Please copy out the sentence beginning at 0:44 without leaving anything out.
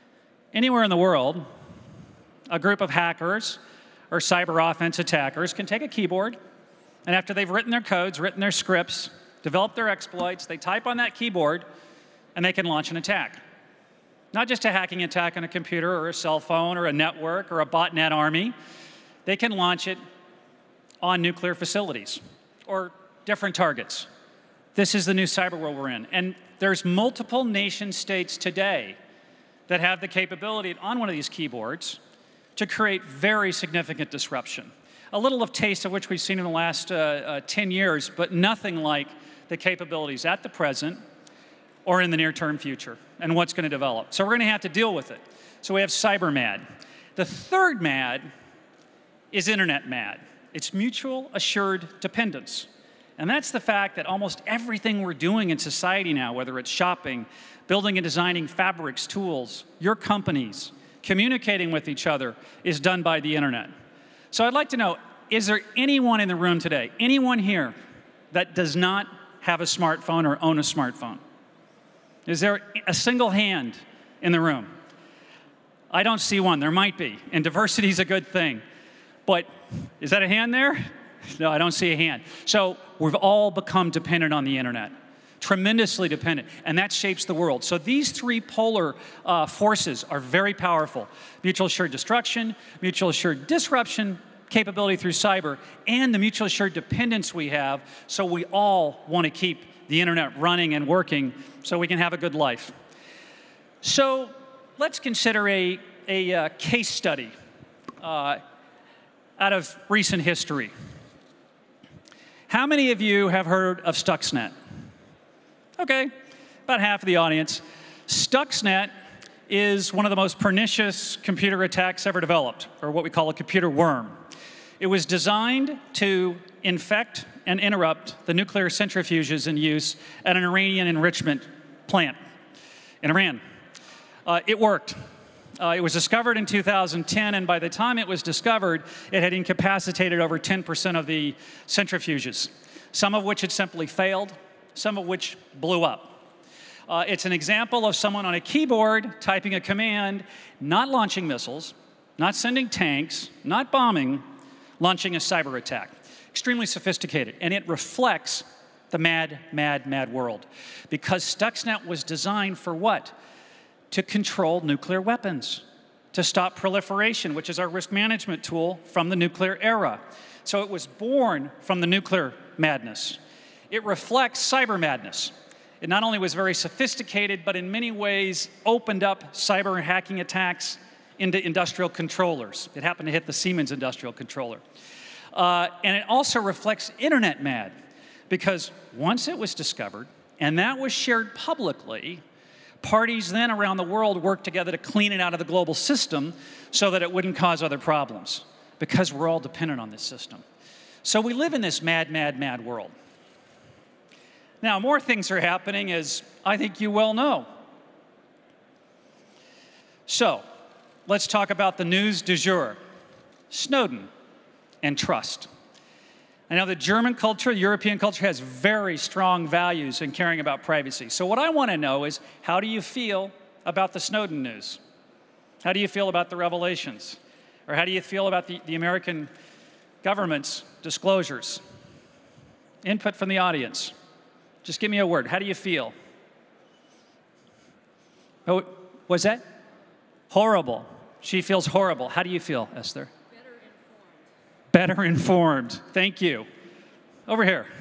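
So we're going to have to deal with it.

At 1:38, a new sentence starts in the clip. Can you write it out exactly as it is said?
So we all want to keep the internet running and working so we can have a good life.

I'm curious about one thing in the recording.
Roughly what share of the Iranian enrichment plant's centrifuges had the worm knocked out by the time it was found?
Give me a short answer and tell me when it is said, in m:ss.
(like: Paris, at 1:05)
over 10%, at 2:20.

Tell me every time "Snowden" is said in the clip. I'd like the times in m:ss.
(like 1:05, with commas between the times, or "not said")
3:33, 3:43.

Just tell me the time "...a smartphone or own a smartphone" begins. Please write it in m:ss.
1:09.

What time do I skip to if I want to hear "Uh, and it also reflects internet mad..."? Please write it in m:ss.
3:05.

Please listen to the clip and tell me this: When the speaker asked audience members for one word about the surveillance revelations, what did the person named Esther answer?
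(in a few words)
better informed.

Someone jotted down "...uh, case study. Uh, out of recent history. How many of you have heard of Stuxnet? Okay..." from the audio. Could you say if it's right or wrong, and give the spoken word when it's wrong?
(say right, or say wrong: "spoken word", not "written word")
right.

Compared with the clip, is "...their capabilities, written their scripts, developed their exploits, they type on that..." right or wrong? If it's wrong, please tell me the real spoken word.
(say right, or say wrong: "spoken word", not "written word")
wrong: "codes", not "capabilities".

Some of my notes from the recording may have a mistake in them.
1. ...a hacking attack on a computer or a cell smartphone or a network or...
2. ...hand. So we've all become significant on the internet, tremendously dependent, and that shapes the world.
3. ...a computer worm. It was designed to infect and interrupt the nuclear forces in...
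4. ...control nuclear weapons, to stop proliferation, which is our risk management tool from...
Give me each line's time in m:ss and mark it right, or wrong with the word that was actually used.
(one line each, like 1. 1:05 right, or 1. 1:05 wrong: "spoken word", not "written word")
1. 0:14 wrong: "phone", not "smartphone"
2. 1:21 wrong: "dependent", not "significant"
3. 2:03 wrong: "centrifuges", not "forces"
4. 2:44 right.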